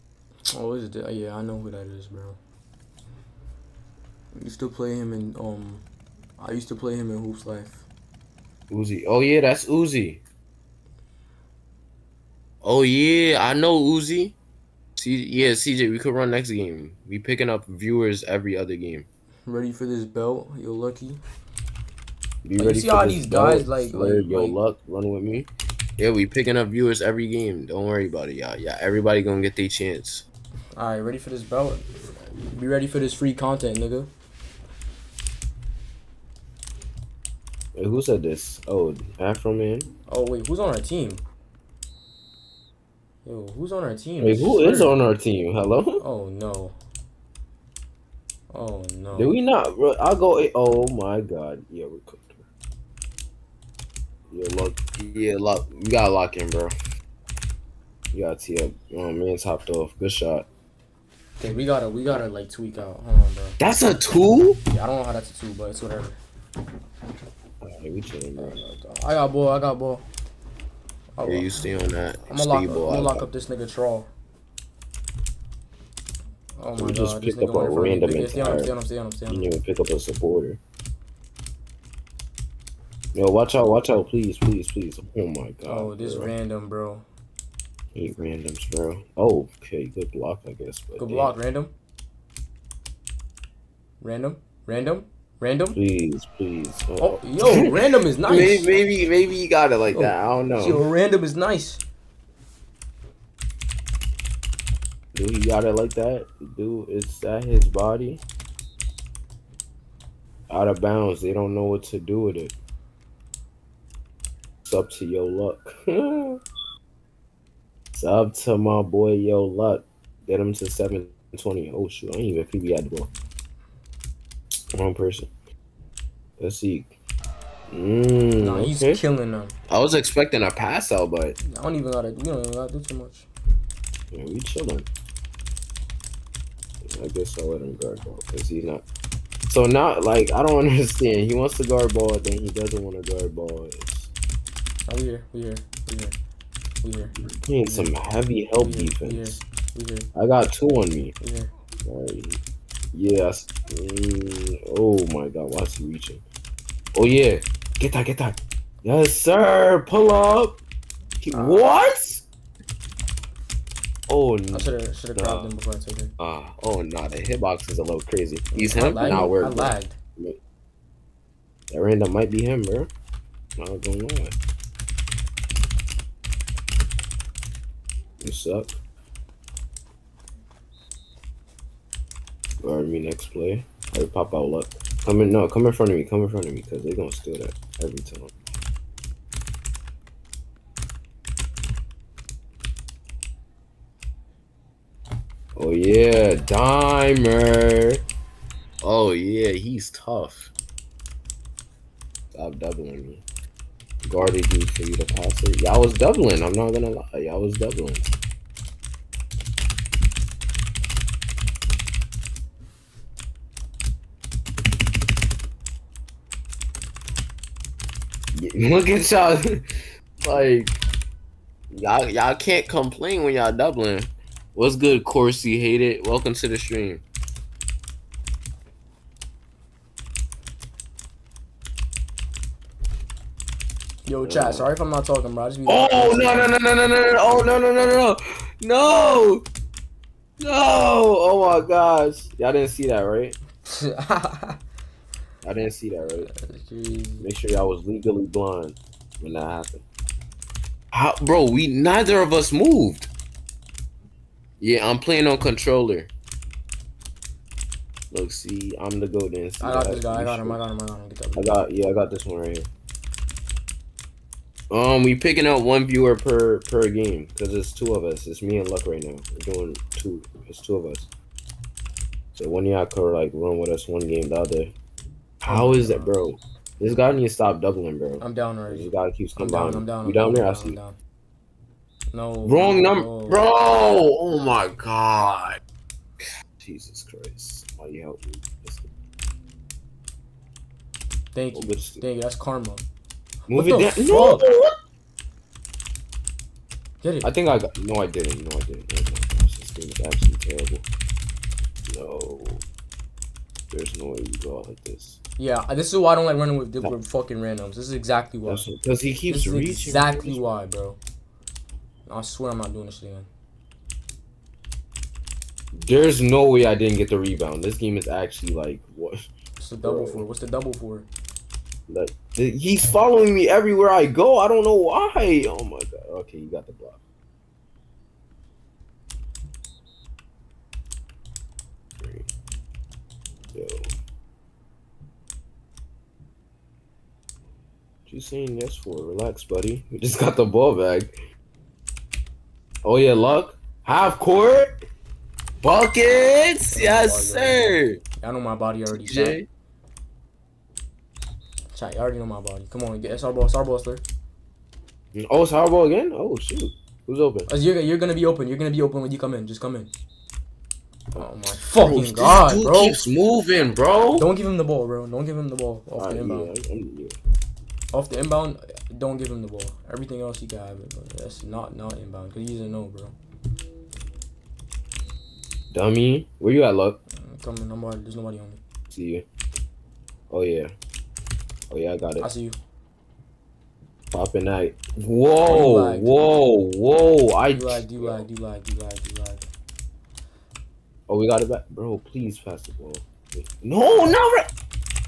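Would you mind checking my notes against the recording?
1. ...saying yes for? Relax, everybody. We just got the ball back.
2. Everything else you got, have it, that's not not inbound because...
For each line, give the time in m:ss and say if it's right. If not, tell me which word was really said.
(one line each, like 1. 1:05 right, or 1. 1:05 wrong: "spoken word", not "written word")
1. 5:38 wrong: "buddy", not "everybody"
2. 6:09 right.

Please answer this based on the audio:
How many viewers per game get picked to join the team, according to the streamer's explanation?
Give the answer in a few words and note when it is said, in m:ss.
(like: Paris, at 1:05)
1, at 4:25.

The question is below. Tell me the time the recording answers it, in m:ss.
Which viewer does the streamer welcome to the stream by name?
3:45.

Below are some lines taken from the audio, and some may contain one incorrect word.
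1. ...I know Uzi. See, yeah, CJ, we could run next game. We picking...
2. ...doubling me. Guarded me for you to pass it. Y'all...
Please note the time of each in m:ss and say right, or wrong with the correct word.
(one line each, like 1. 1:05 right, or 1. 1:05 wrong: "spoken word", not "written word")
1. 0:13 right
2. 3:22 right.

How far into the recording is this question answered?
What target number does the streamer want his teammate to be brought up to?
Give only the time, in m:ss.
2:00.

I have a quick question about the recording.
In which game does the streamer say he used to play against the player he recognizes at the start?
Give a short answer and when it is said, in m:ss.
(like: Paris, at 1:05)
Hoops Life, at 0:07.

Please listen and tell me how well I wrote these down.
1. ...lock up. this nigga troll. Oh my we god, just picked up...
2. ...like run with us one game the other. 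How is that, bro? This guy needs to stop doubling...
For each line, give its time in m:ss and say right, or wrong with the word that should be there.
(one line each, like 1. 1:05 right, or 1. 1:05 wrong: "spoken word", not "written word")
1. 1:13 right
2. 4:33 right.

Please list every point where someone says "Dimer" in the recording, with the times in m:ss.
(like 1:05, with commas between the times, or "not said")
3:16.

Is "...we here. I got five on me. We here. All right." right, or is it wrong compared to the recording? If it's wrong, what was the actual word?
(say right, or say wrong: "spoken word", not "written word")
wrong: "two", not "five".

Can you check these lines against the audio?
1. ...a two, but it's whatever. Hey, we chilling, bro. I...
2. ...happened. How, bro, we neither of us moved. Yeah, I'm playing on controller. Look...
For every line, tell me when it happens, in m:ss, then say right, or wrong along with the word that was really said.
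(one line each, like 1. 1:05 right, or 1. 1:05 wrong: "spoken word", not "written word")
1. 1:05 right
2. 4:09 right.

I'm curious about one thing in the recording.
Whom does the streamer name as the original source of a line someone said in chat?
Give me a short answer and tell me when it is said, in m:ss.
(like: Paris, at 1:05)
Afro Man, at 0:39.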